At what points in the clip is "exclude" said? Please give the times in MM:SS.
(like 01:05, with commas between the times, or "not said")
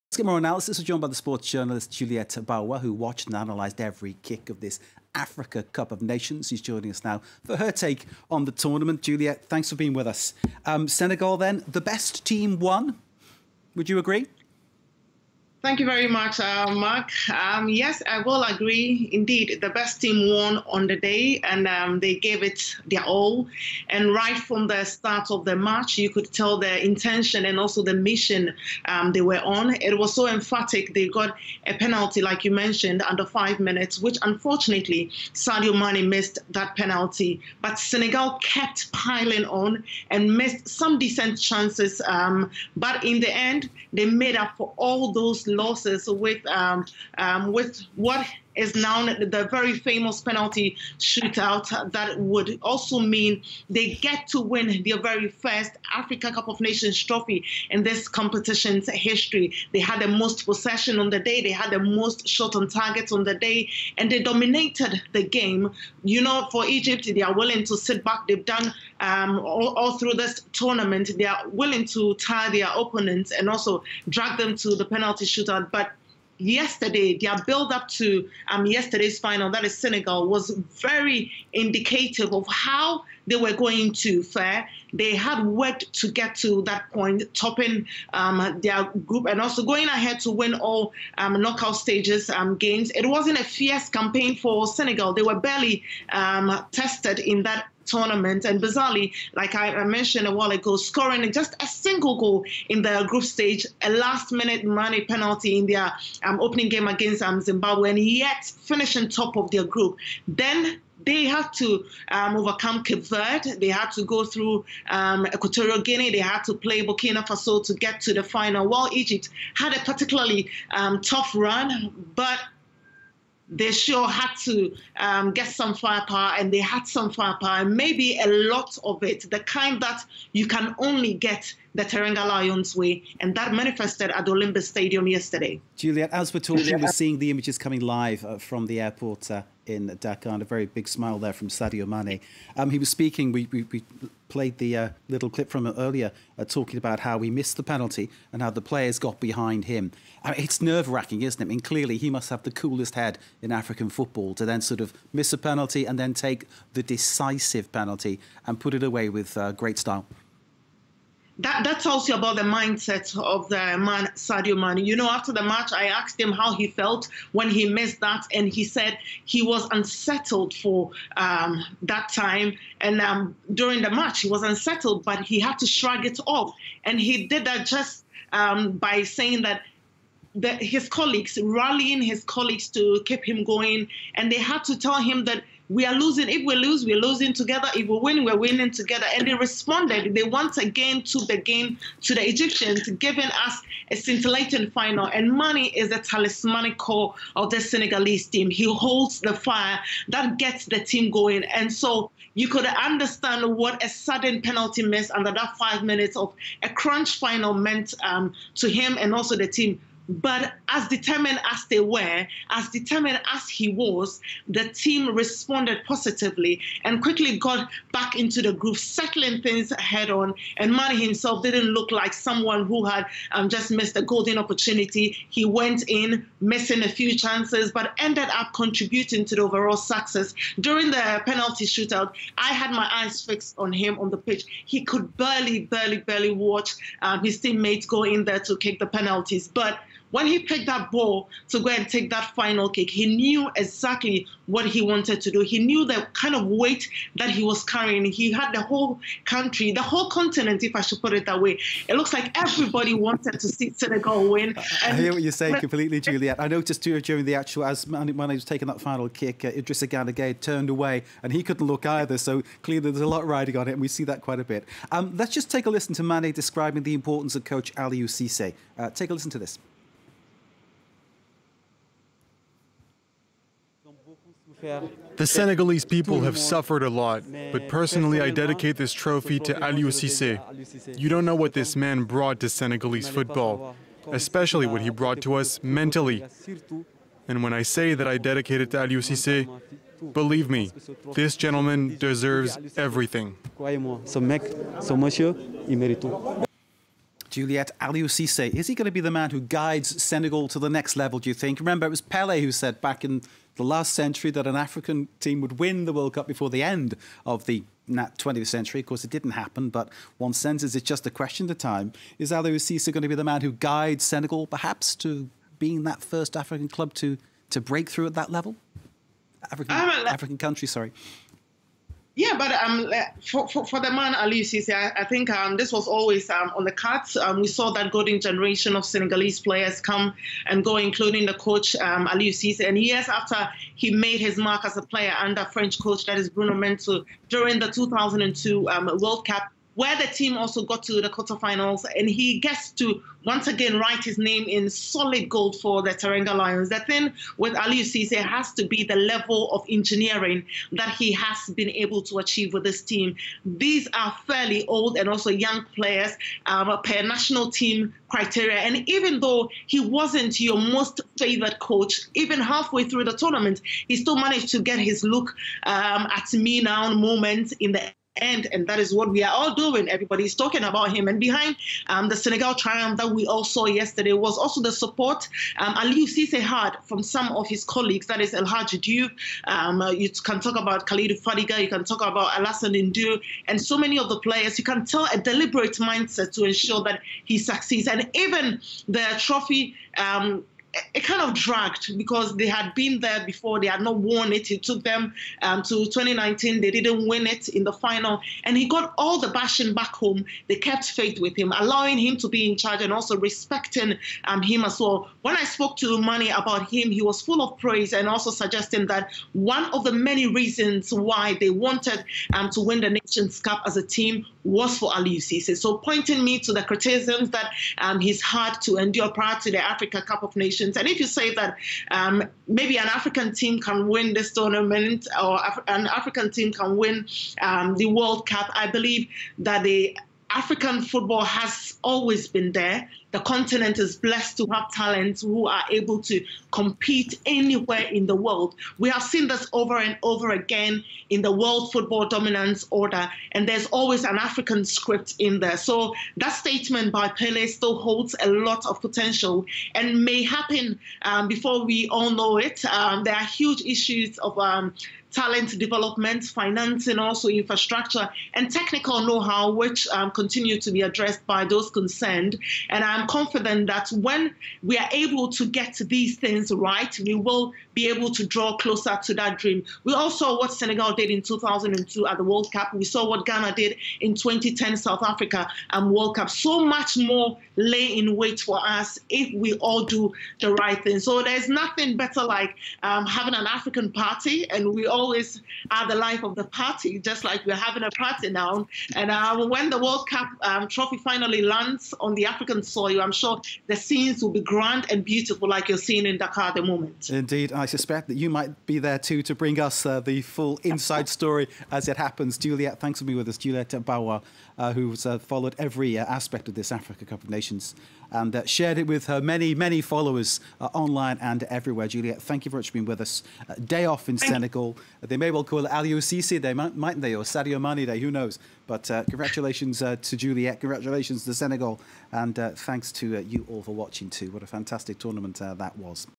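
not said.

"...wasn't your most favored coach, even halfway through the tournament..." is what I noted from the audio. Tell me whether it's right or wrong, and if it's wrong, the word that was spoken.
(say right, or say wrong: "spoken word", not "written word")
right.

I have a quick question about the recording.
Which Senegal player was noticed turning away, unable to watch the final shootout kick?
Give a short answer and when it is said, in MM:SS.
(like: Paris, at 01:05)
Idrissa Gana, at 04:19.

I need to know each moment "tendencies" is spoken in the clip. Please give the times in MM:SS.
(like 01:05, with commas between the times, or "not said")
not said.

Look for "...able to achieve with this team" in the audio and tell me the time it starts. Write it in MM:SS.
05:51.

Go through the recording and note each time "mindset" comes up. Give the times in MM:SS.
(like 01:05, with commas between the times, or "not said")
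02:42, 06:25.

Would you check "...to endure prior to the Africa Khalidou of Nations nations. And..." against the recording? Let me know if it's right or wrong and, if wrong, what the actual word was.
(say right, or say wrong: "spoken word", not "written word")
wrong: "Cup", not "Khalidou".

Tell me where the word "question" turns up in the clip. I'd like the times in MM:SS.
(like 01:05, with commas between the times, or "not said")
05:11.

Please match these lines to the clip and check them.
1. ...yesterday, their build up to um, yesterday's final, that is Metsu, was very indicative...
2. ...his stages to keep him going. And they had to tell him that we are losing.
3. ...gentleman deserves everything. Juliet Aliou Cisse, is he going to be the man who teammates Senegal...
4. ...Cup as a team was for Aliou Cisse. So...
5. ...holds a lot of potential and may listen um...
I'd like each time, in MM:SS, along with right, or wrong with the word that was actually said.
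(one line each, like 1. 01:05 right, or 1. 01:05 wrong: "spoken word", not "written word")
1. 01:16 wrong: "Senegal", not "Metsu"
2. 03:02 wrong: "colleagues", not "stages"
3. 04:51 wrong: "guides", not "teammates"
4. 06:53 right
5. 07:27 wrong: "happen", not "listen".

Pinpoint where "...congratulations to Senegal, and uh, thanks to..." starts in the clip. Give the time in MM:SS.
08:40.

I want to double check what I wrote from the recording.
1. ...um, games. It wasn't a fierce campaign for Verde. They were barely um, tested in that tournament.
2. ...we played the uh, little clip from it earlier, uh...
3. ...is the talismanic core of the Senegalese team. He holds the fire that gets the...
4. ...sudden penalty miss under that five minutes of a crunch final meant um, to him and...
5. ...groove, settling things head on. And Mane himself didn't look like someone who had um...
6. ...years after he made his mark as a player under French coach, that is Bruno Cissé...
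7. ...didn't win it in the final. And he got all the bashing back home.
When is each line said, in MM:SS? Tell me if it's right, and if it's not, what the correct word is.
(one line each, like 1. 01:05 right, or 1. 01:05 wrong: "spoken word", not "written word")
1. 01:32 wrong: "Senegal", not "Verde"
2. 02:23 right
3. 03:15 right
4. 03:23 right
5. 03:38 right
6. 05:32 wrong: "Metsu", not "Cissé"
7. 06:36 right.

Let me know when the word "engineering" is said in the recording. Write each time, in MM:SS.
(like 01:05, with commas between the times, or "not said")
05:49.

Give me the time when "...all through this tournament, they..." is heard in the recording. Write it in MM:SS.
01:09.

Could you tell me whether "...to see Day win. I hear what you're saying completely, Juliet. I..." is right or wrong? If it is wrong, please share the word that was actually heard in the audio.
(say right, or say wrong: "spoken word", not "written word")
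wrong: "Senegal", not "Day".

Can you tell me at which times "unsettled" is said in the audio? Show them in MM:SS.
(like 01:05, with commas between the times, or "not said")
02:49, 02:54.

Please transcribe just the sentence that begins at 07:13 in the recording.
The continent is blessed to have talents who are able to compete anywhere in the world.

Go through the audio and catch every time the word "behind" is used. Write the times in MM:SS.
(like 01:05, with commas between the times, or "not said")
02:29, 06:11.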